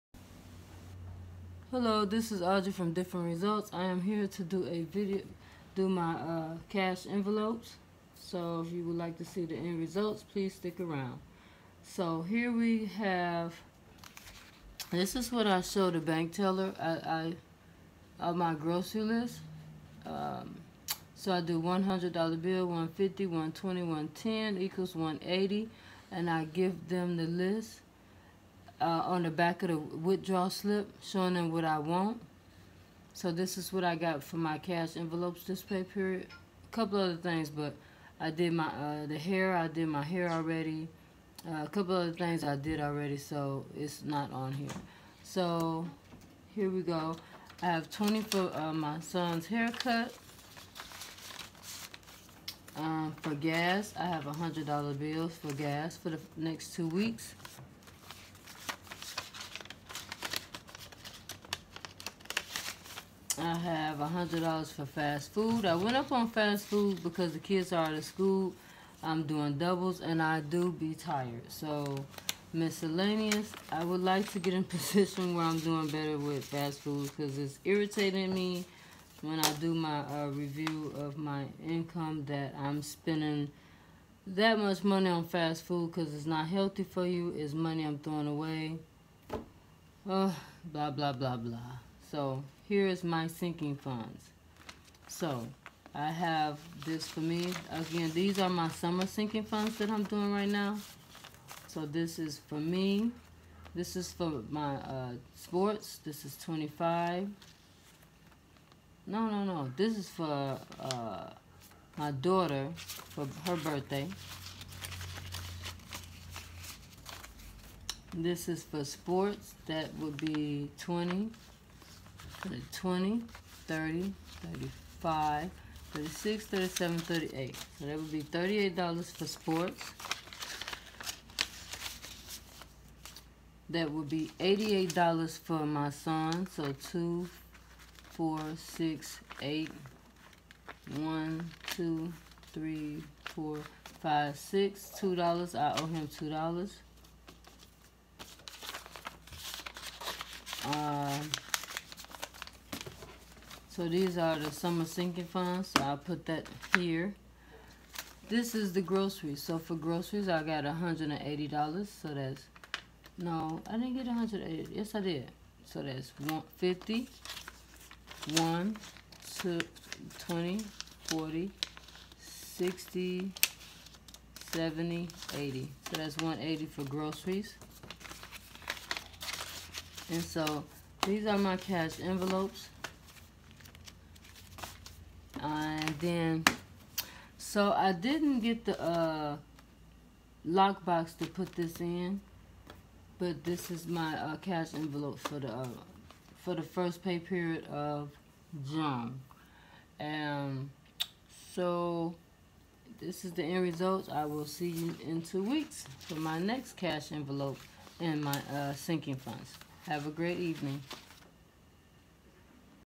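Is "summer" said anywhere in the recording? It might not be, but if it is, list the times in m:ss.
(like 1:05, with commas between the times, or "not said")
1:38, 2:34.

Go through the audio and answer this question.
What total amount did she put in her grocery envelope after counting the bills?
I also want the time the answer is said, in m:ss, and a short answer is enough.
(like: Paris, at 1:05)
$180, at 2:56.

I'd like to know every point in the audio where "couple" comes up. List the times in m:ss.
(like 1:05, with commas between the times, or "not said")
0:36, 0:41.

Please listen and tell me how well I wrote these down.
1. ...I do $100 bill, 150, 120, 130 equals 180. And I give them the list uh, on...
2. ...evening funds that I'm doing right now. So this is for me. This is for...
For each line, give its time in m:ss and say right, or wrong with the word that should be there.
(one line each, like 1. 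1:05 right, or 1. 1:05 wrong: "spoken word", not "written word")
1. 0:21 wrong: "110", not "130"
2. 1:39 wrong: "sinking", not "evening".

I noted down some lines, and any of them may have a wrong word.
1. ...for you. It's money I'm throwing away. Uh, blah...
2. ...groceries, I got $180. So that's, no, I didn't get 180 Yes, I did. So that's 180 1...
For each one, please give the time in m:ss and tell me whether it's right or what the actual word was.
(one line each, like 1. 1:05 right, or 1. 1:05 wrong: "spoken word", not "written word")
1. 1:26 right
2. 2:39 wrong: "150", not "180".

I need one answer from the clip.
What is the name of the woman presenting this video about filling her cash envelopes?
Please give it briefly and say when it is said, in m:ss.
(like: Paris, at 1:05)
Audrey, at 0:02.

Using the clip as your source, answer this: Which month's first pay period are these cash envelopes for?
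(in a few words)
June.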